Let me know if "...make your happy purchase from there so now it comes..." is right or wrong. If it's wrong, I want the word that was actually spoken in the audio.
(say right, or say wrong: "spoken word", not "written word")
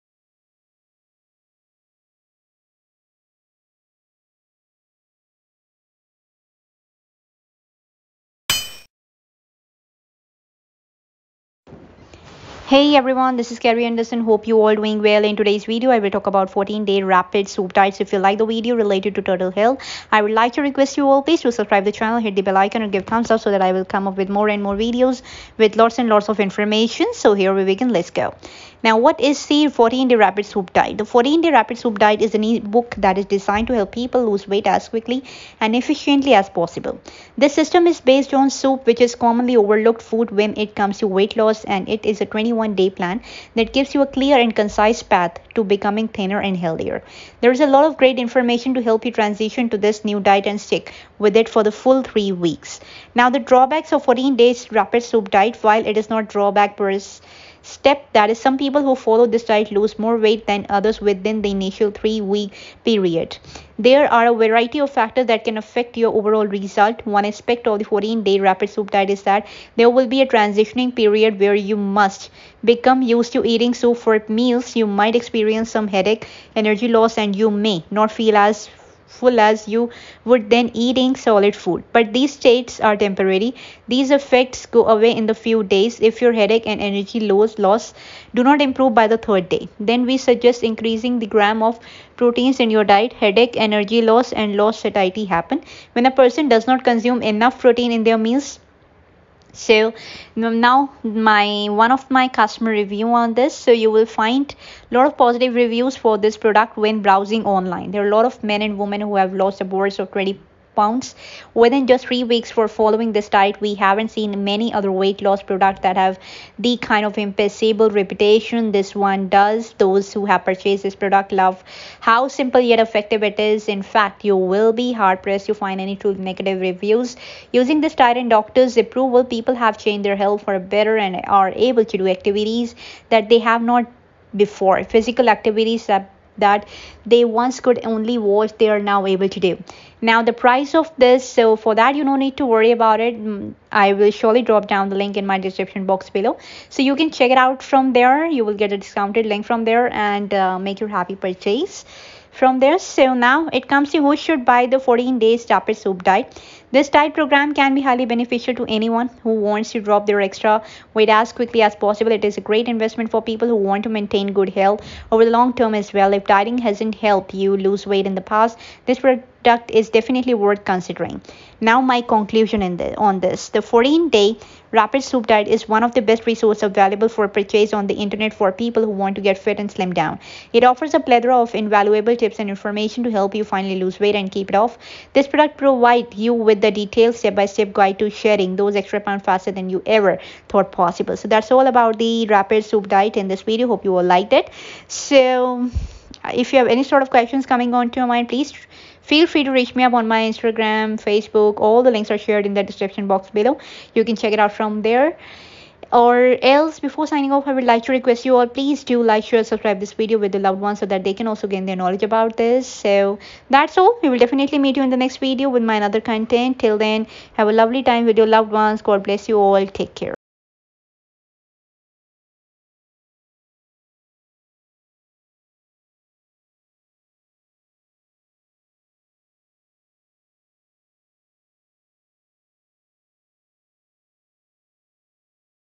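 right.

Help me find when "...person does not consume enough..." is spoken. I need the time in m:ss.
1:36.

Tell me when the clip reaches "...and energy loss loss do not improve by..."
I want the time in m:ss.
1:26.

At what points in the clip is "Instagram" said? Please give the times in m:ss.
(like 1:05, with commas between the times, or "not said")
3:20.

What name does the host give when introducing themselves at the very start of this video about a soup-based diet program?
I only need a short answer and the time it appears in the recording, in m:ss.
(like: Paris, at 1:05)
Kerry Anderson, at 0:13.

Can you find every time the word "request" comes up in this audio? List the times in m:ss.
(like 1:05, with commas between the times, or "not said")
0:20, 3:27.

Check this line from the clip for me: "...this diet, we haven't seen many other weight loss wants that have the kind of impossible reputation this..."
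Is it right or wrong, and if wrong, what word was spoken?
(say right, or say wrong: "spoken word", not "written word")
wrong: "products", not "wants".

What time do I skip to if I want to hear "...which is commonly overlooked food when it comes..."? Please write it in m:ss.
0:38.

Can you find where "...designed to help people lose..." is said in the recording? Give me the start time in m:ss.
0:33.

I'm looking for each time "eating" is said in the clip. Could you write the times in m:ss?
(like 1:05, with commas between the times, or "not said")
1:13, 1:20.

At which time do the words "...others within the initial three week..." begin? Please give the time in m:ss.
1:00.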